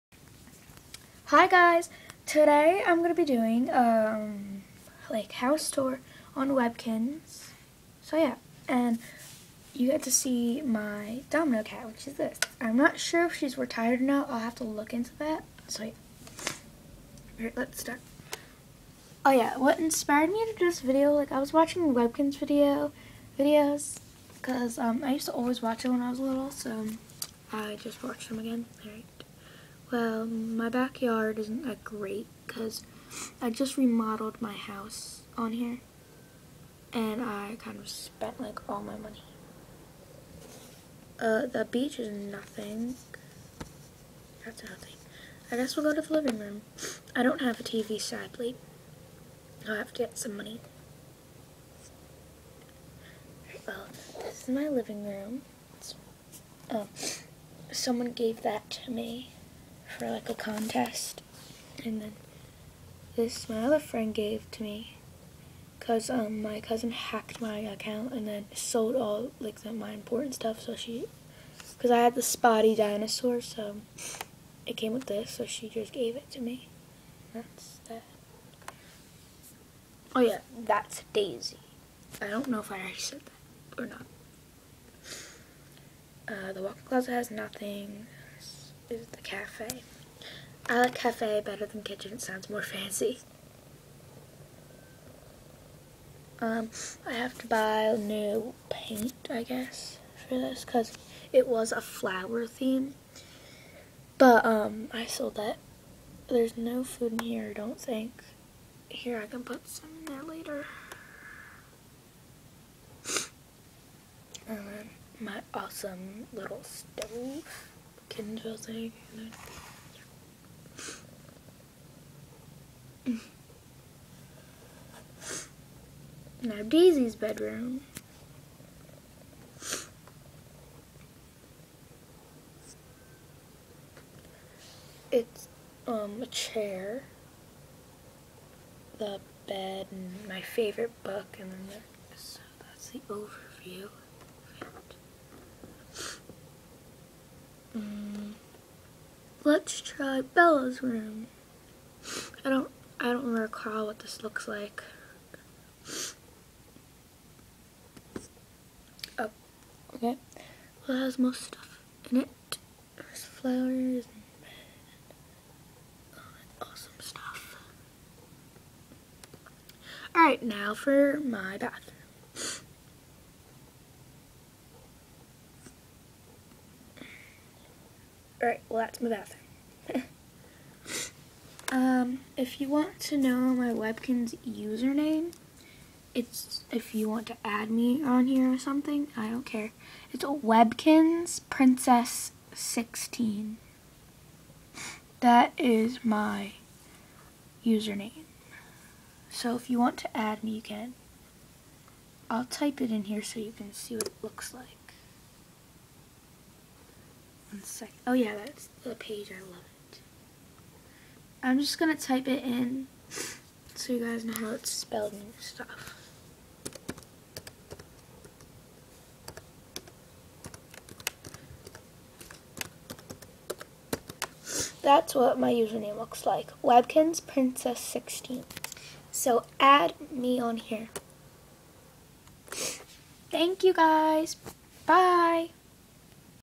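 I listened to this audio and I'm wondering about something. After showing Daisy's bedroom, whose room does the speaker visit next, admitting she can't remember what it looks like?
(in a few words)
Bella's room.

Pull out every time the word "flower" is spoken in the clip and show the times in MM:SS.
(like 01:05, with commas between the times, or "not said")
01:41, 02:43.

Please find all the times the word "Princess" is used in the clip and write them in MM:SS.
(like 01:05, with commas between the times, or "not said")
03:11, 03:47.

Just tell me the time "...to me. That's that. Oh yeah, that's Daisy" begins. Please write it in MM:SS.
01:16.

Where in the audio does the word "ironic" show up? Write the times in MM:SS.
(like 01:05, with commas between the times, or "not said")
not said.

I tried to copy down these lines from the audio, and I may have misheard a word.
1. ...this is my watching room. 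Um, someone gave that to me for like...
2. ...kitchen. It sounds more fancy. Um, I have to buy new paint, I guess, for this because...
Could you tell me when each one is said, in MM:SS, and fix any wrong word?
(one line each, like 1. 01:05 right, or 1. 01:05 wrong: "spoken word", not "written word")
1. 00:54 wrong: "living", not "watching"
2. 01:31 right.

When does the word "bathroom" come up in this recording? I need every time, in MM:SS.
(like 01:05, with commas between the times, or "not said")
02:51, 02:59.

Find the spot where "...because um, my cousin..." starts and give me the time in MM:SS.
01:05.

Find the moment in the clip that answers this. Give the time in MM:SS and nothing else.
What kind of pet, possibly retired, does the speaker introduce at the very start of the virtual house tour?
00:11.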